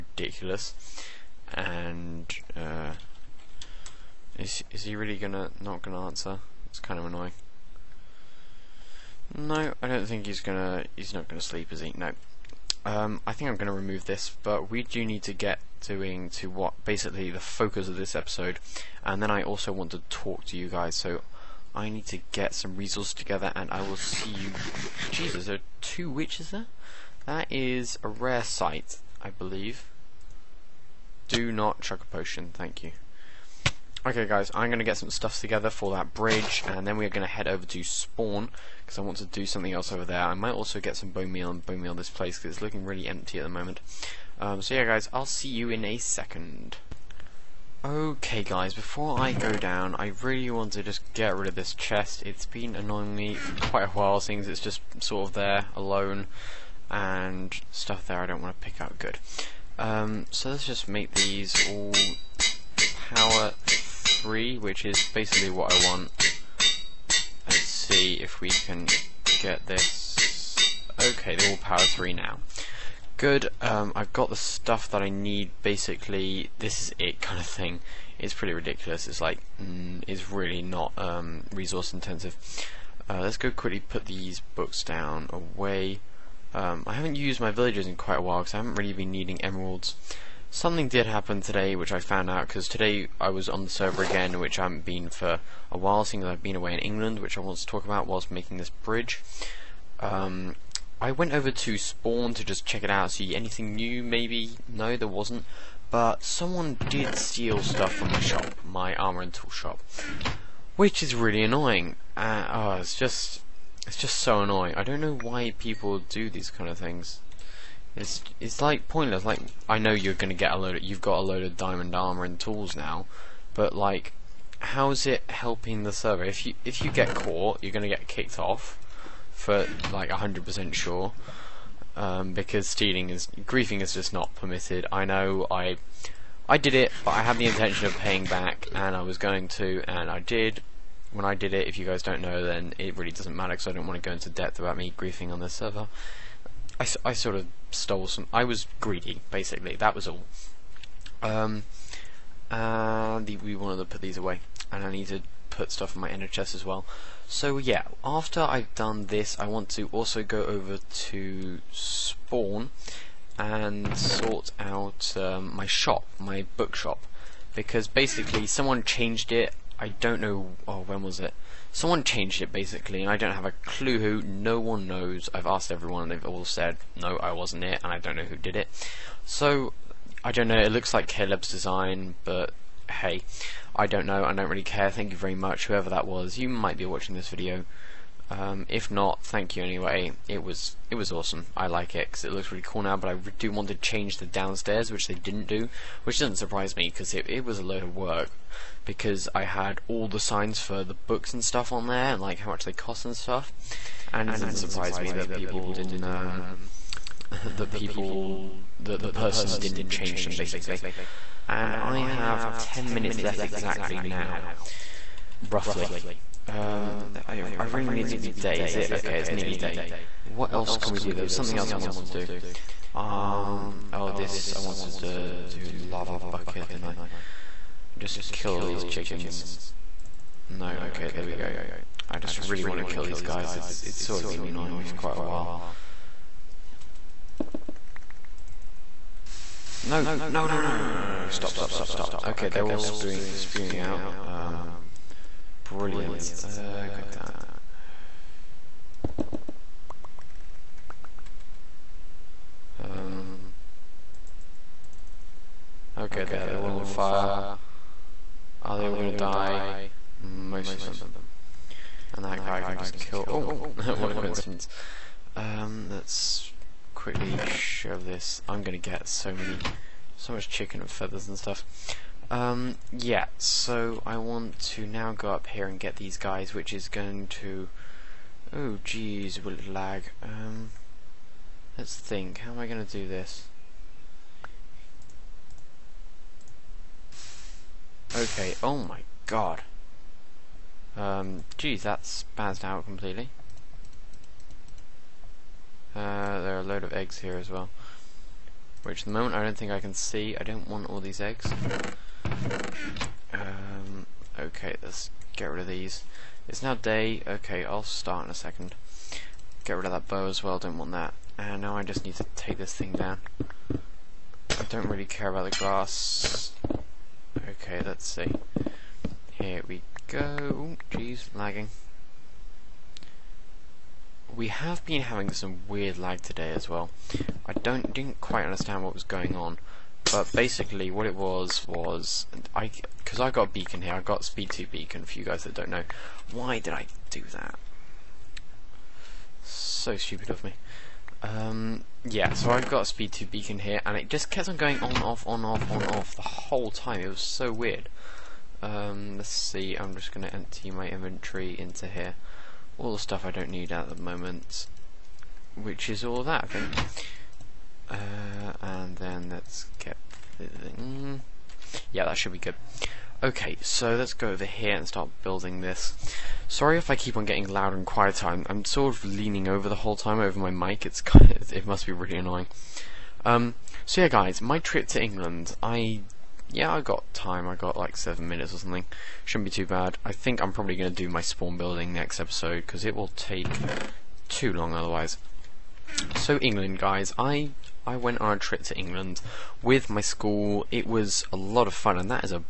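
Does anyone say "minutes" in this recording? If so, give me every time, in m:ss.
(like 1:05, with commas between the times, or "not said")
3:32, 6:18.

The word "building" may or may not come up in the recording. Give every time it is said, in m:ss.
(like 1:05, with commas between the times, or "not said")
6:05, 6:21.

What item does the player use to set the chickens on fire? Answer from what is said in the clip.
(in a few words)
lava bucket.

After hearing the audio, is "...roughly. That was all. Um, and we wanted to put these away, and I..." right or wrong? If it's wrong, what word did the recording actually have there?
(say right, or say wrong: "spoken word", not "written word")
wrong: "basically", not "roughly".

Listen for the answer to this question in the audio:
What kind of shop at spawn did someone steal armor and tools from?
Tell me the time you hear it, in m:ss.
1:48.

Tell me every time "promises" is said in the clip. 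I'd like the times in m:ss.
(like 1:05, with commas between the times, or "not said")
not said.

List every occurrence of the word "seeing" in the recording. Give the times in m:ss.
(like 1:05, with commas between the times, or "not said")
0:54, 1:36.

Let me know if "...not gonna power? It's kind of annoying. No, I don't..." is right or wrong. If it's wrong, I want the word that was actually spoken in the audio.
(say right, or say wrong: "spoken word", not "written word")
wrong: "answer", not "power".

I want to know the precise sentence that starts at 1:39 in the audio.
Um, I went over to Spawn to just check it out, see anything new maybe.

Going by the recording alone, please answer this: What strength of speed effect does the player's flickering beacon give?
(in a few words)
speed 2.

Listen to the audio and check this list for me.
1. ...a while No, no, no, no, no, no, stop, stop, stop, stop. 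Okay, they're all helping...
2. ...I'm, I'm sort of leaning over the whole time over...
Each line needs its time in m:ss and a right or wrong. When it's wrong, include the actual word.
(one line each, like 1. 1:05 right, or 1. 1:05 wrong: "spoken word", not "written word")
1. 3:55 wrong: "spewing", not "helping"
2. 6:08 right.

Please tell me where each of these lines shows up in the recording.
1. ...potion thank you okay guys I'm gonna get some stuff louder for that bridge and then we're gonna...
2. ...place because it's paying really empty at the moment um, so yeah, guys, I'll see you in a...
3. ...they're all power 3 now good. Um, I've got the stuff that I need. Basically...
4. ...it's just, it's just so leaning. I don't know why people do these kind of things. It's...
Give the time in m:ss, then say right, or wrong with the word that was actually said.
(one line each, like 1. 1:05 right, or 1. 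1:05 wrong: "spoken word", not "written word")
1. 0:32 wrong: "together", not "louder"
2. 0:42 wrong: "looking", not "paying"
3. 1:11 right
4. 1:52 wrong: "annoying", not "leaning".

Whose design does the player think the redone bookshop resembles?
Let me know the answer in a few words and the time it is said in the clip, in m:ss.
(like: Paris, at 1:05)
Caleb, at 3:01.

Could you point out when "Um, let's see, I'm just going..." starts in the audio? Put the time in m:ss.
5:48.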